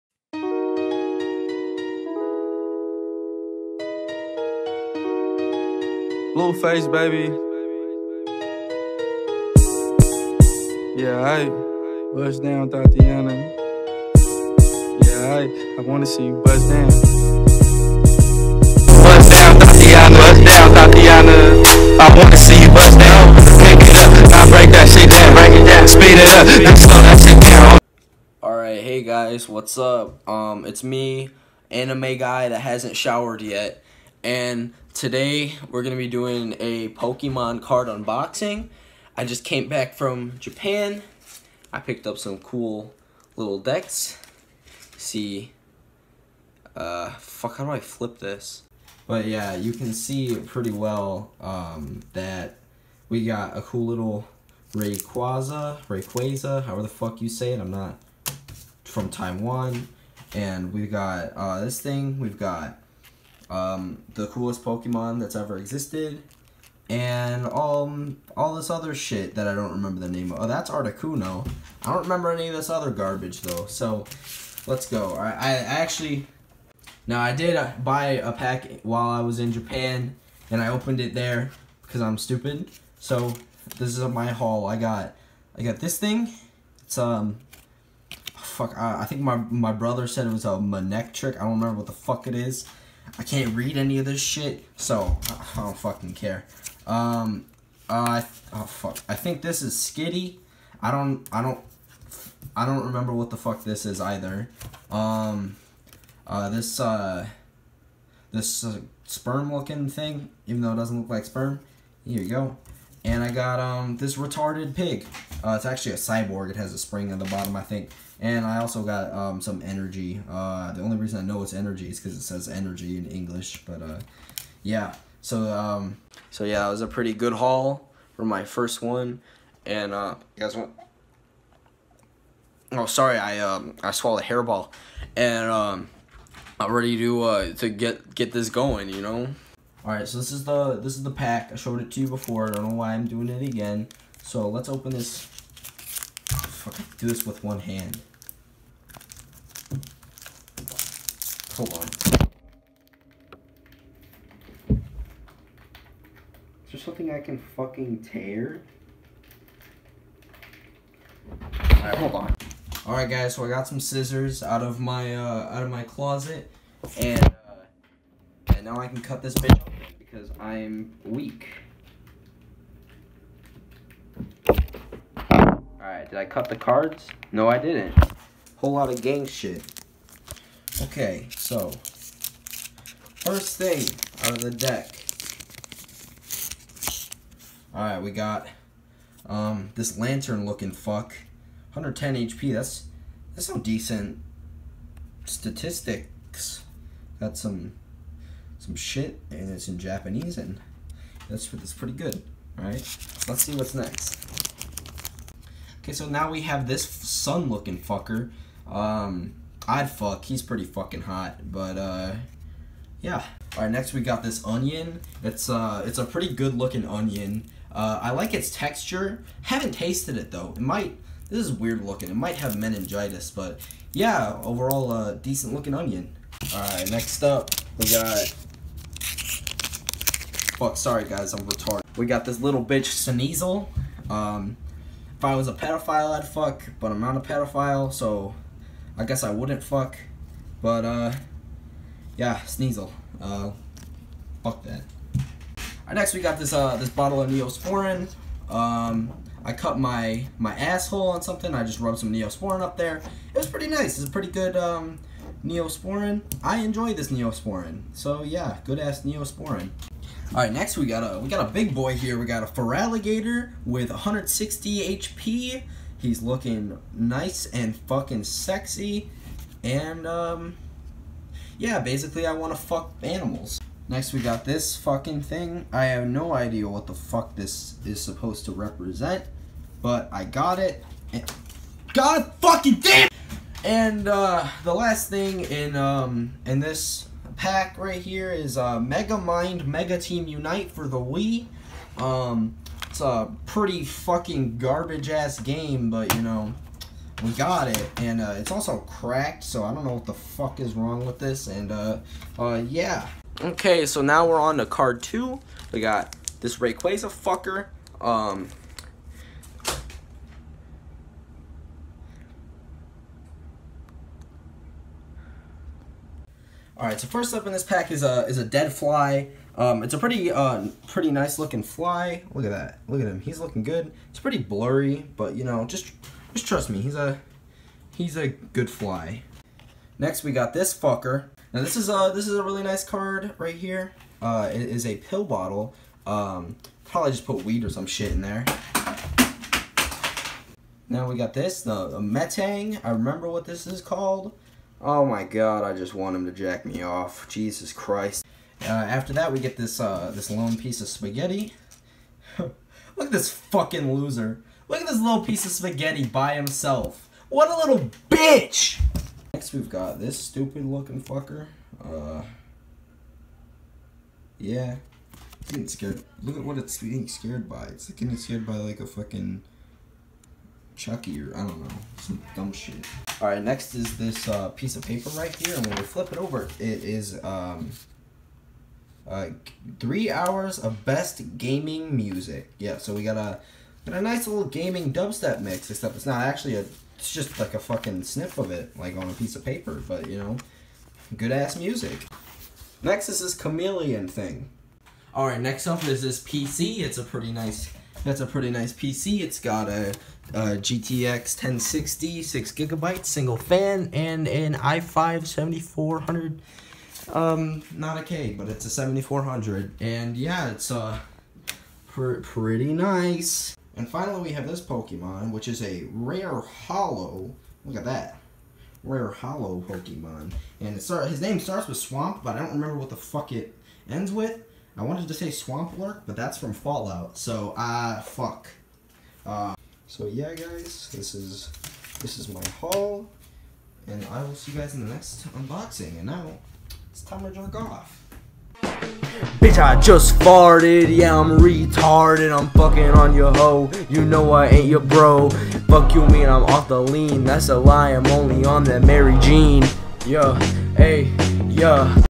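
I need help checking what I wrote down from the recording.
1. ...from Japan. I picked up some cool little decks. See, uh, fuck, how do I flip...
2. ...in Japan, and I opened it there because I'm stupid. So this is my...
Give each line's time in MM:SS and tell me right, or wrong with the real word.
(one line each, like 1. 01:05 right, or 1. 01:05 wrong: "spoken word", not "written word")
1. 00:39 right
2. 01:19 right.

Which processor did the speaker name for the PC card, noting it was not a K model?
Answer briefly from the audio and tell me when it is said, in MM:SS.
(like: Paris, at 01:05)
i5 7400, at 06:44.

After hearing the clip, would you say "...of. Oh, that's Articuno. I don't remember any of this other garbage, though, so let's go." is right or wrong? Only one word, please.
right.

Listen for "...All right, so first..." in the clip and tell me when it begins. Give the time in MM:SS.
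05:16.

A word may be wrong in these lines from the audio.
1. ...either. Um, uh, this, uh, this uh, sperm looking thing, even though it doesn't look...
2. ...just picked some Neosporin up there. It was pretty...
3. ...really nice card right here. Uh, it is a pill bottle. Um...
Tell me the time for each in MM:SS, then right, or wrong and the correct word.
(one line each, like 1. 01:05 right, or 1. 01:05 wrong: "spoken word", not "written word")
1. 01:43 right
2. 04:11 wrong: "rubbed", not "picked"
3. 05:32 right.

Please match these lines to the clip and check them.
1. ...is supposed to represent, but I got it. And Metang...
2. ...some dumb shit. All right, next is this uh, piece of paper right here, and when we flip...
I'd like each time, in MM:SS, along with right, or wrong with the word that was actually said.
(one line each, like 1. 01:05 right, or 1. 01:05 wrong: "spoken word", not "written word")
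1. 04:37 wrong: "God", not "Metang"
2. 06:12 right.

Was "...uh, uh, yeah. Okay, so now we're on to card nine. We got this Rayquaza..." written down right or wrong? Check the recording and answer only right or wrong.
wrong.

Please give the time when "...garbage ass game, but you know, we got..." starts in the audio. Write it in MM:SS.
04:54.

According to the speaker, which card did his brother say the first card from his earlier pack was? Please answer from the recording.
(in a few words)
Manectric.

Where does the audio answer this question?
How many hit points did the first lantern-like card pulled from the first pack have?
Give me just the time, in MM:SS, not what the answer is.
03:11.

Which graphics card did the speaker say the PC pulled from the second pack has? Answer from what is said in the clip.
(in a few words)
GTX 1060.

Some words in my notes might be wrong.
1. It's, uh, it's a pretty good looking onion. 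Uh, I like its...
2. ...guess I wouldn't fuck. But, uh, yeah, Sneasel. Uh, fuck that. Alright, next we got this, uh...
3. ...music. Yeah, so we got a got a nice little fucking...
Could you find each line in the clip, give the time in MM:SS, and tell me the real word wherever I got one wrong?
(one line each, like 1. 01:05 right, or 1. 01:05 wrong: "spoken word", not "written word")
1. 03:35 right
2. 03:59 right
3. 06:21 wrong: "gaming", not "fucking".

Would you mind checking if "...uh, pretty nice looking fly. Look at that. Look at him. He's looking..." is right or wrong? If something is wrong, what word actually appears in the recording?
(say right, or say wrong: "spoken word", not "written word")
right.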